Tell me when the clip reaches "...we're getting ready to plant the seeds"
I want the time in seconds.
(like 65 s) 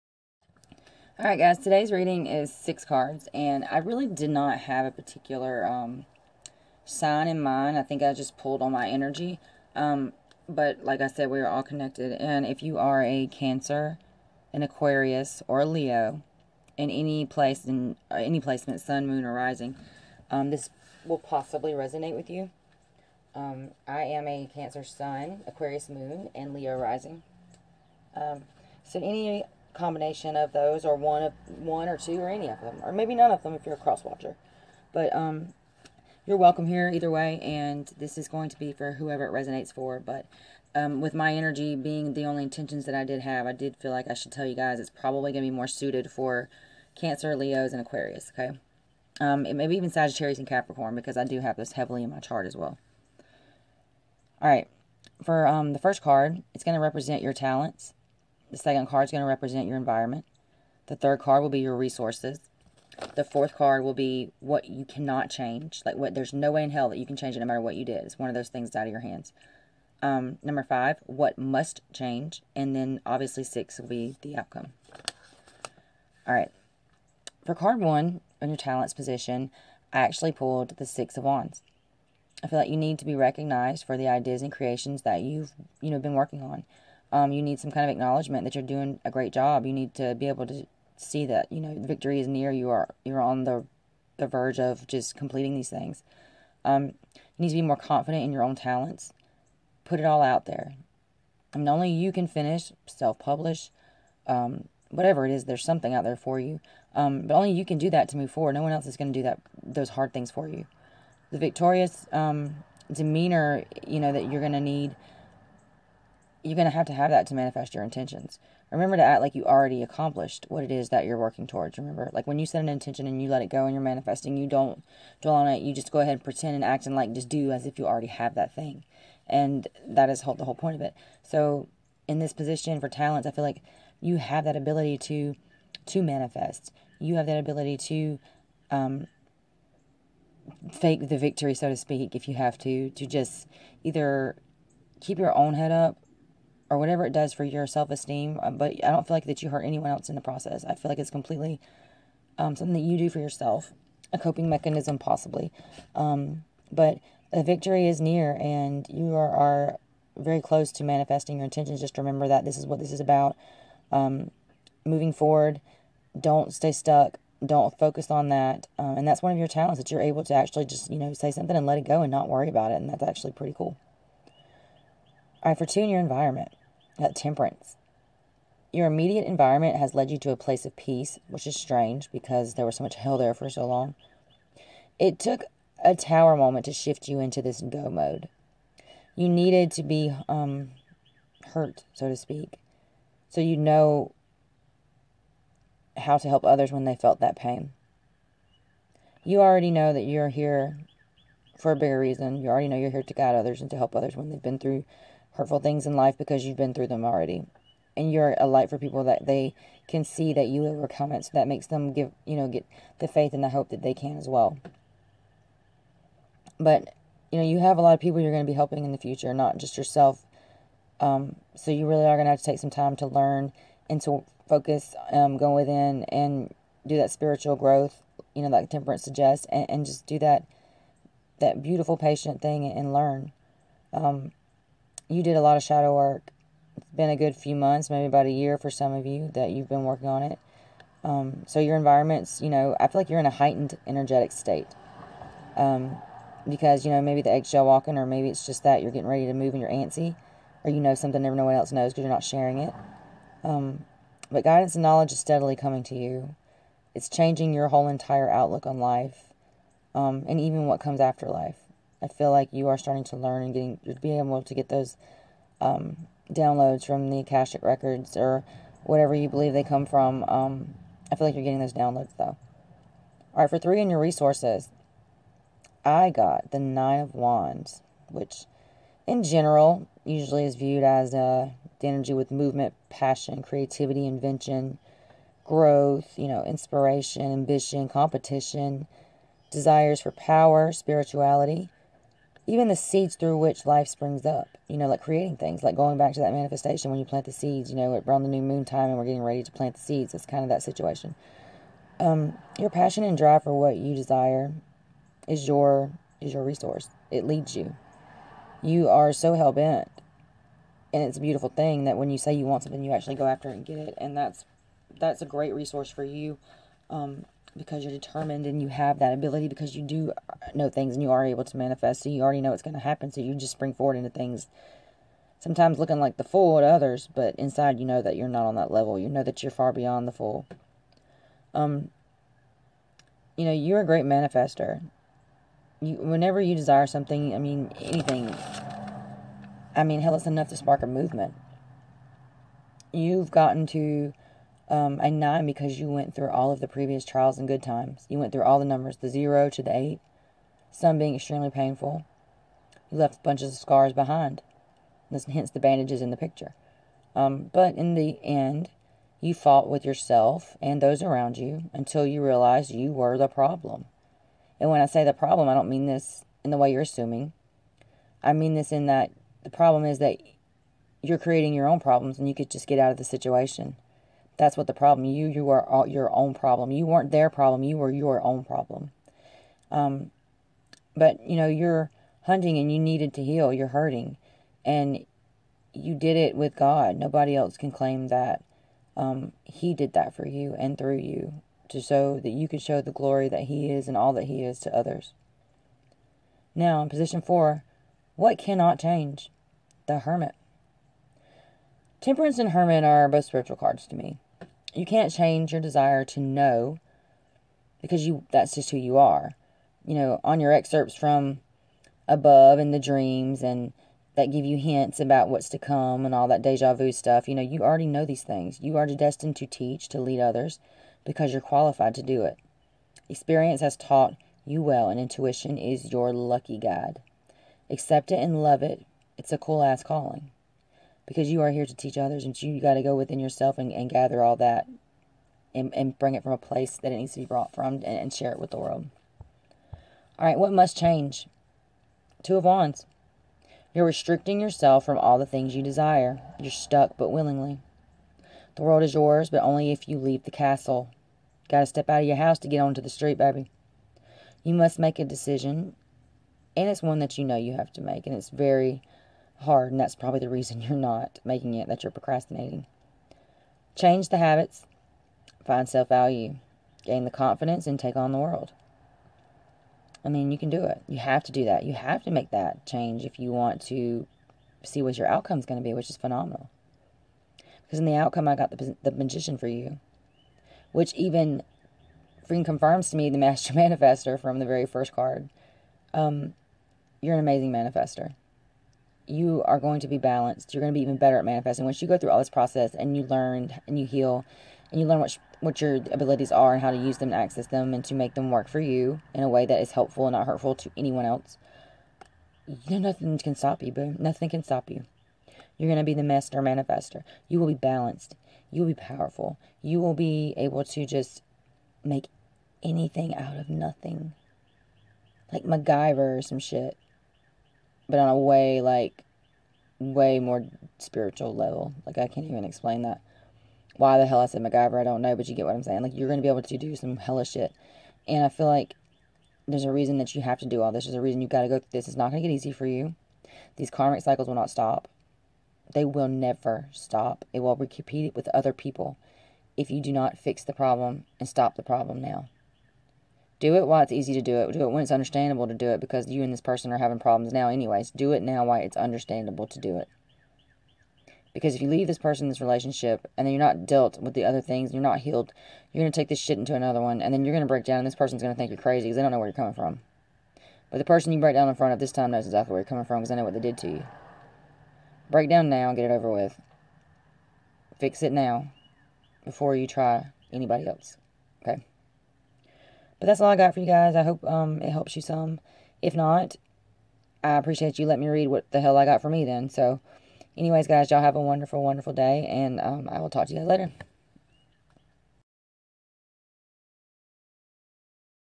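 298 s.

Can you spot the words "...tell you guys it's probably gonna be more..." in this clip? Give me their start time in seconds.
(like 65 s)
44 s.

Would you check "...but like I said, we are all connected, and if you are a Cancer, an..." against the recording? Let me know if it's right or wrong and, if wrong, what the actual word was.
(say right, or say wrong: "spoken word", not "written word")
right.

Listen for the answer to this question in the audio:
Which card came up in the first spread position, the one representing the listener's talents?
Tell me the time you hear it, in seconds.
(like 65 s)
80 s.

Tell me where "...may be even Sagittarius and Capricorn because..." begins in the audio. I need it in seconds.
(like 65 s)
49 s.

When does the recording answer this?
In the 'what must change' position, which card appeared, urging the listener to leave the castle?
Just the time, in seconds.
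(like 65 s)
442 s.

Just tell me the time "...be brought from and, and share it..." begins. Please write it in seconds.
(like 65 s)
437 s.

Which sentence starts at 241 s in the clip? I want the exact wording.
Um, so your environment's, you know, I feel like you're in a heightened energetic state.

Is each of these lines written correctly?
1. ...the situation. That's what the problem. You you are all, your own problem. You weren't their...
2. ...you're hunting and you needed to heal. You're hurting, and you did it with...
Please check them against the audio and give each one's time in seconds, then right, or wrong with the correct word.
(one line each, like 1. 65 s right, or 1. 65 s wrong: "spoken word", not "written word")
1. 372 s right
2. 381 s right.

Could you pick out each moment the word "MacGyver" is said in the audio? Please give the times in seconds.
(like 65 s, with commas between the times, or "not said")
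515 s, 524 s.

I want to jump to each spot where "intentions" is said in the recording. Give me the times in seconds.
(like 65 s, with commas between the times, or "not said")
42 s, 117 s, 122 s, 161 s.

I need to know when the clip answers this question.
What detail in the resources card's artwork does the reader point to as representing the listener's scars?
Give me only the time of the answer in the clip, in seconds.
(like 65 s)
355 s.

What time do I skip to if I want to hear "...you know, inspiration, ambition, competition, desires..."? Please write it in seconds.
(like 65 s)
286 s.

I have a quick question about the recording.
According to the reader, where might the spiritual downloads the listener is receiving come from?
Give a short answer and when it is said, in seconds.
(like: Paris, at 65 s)
Akashic records, at 267 s.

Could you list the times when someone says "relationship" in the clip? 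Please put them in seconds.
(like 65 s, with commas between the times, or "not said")
552 s.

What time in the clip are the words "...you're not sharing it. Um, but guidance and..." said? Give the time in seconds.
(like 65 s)
252 s.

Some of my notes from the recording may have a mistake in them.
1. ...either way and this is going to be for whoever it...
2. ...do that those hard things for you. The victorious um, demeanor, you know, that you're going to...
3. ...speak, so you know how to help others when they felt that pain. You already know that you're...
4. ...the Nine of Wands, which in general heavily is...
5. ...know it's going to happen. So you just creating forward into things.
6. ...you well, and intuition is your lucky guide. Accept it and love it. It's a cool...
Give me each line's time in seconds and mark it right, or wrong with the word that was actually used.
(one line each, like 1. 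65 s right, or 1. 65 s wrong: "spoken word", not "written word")
1. 36 s right
2. 109 s right
3. 192 s right
4. 276 s wrong: "usually", not "heavily"
5. 322 s wrong: "spring", not "creating"
6. 424 s right.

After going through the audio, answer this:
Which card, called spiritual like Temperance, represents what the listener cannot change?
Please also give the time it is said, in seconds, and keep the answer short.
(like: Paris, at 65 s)
The Hermit, at 399 s.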